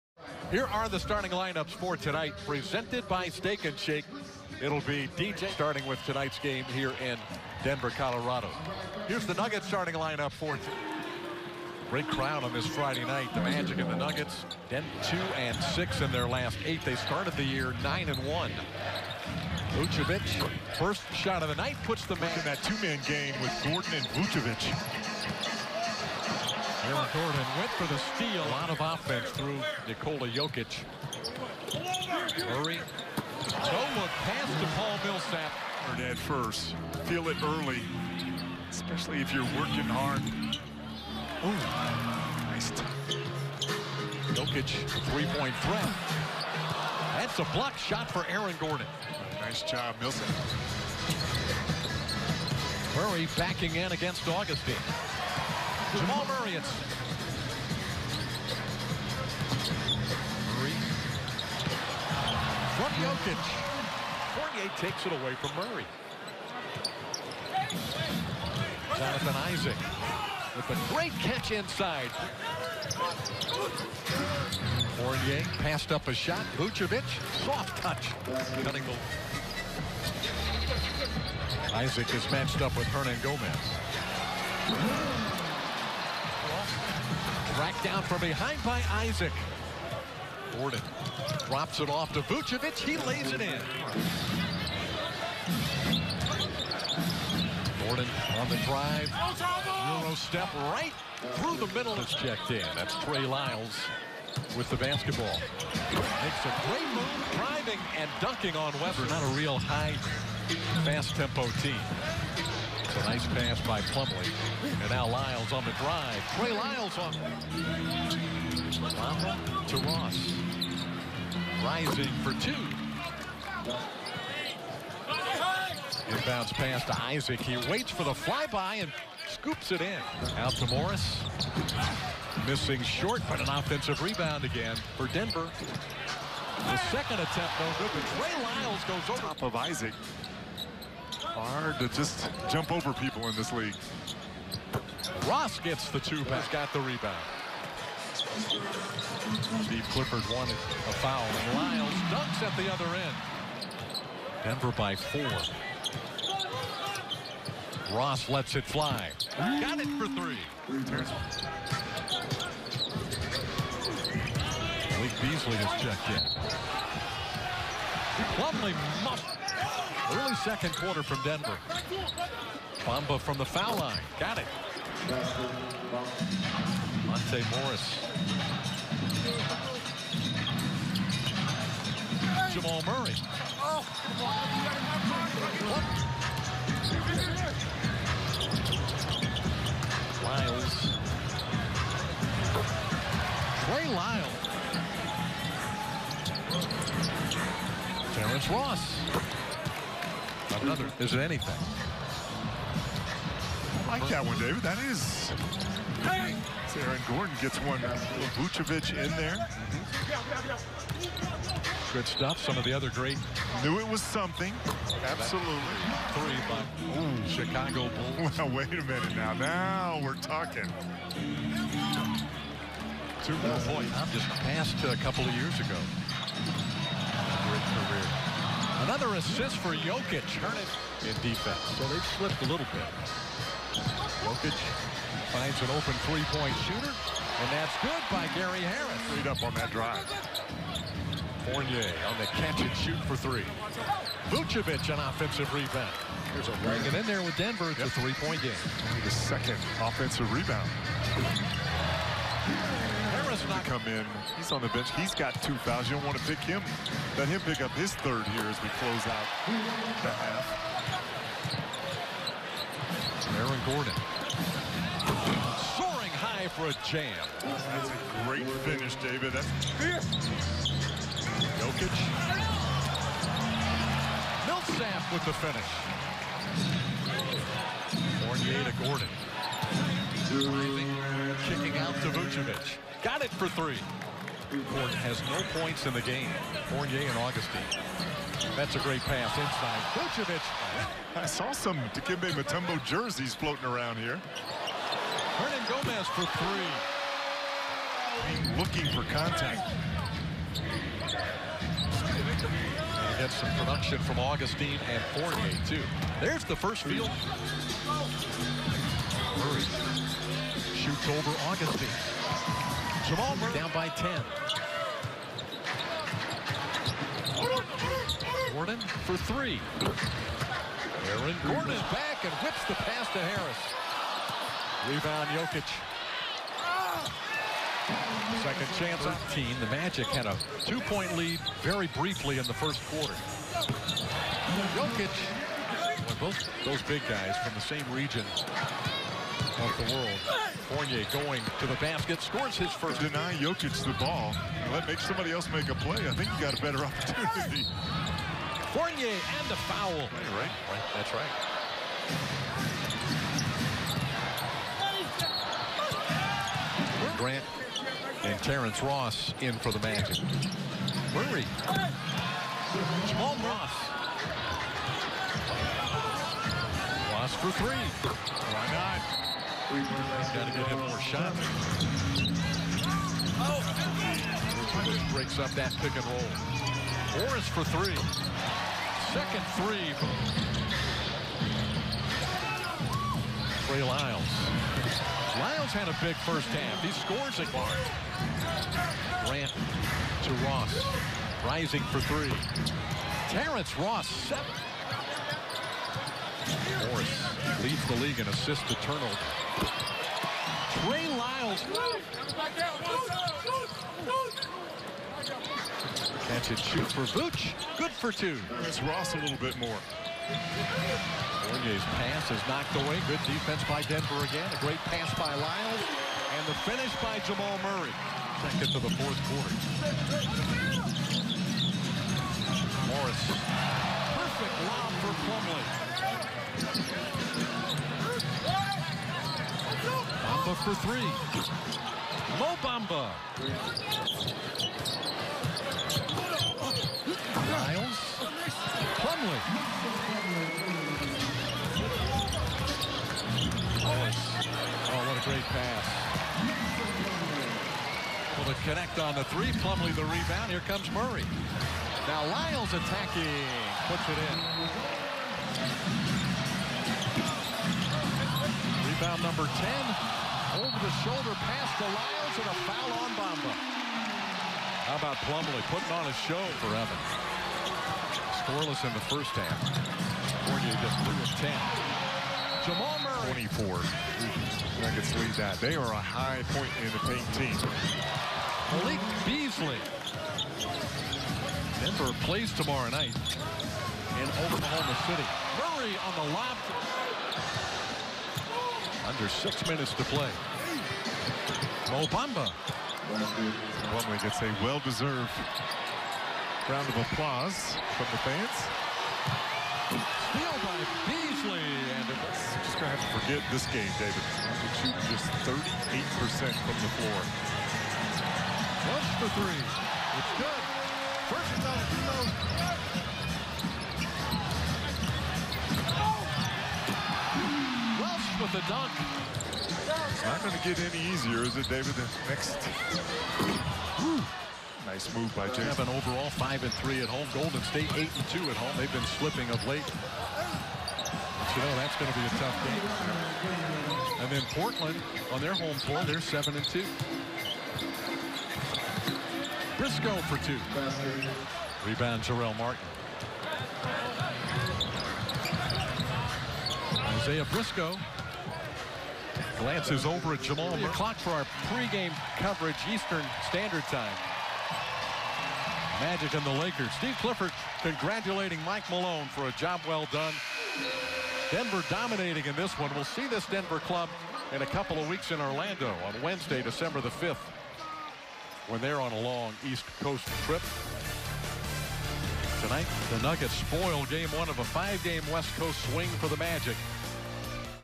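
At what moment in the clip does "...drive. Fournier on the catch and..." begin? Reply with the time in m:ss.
3:59.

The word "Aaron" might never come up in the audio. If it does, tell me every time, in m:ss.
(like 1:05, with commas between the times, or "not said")
0:26, 0:48, 3:26, 4:23, 5:21.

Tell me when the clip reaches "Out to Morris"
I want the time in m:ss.
2:10.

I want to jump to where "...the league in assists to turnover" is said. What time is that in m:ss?
6:37.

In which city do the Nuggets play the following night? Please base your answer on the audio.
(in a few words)
Oklahoma City.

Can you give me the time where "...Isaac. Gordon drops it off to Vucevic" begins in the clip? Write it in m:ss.
1:28.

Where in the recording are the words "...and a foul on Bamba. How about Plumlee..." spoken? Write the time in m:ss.
7:42.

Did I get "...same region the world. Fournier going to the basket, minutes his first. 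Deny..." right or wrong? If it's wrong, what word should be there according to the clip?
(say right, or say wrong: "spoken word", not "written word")
wrong: "scores", not "minutes".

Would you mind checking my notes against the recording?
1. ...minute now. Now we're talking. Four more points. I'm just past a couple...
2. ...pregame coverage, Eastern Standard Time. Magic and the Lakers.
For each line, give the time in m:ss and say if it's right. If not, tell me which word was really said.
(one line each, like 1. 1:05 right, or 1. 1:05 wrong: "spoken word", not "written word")
1. 3:38 wrong: "Two", not "Four"
2. 9:11 right.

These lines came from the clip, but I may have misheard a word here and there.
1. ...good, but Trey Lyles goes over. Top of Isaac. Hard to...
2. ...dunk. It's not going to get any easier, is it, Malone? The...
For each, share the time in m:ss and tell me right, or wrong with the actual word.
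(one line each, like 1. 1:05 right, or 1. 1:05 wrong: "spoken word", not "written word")
1. 2:17 right
2. 8:38 wrong: "David", not "Malone".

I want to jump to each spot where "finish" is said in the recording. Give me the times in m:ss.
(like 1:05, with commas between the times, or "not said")
4:28, 4:35, 6:56.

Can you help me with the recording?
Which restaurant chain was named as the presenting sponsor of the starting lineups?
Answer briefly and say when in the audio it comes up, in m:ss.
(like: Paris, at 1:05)
Steak and Shake, at 0:03.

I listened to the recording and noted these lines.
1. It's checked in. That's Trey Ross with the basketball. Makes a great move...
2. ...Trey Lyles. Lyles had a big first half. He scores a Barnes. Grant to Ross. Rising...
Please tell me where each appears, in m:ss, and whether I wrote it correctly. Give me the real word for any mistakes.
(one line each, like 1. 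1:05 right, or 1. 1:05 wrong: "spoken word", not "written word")
1. 1:41 wrong: "Lyles", not "Ross"
2. 6:23 right.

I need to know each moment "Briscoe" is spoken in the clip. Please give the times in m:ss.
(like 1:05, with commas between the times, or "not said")
8:59, 9:07.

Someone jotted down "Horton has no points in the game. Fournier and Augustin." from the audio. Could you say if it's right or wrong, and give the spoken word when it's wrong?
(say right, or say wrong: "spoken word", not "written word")
right.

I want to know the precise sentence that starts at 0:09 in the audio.
Here's the Nuggets starting lineup for Great crowd on this Friday night.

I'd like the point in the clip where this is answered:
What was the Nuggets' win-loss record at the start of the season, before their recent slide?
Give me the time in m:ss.
0:17.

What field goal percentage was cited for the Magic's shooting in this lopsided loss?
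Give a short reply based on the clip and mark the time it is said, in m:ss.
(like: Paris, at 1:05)
38%, at 8:25.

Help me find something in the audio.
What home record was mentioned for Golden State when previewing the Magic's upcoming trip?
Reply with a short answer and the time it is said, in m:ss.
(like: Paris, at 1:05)
8 and 2, at 8:47.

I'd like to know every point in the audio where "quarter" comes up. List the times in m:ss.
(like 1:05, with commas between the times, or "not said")
2:50, 5:32, 6:59.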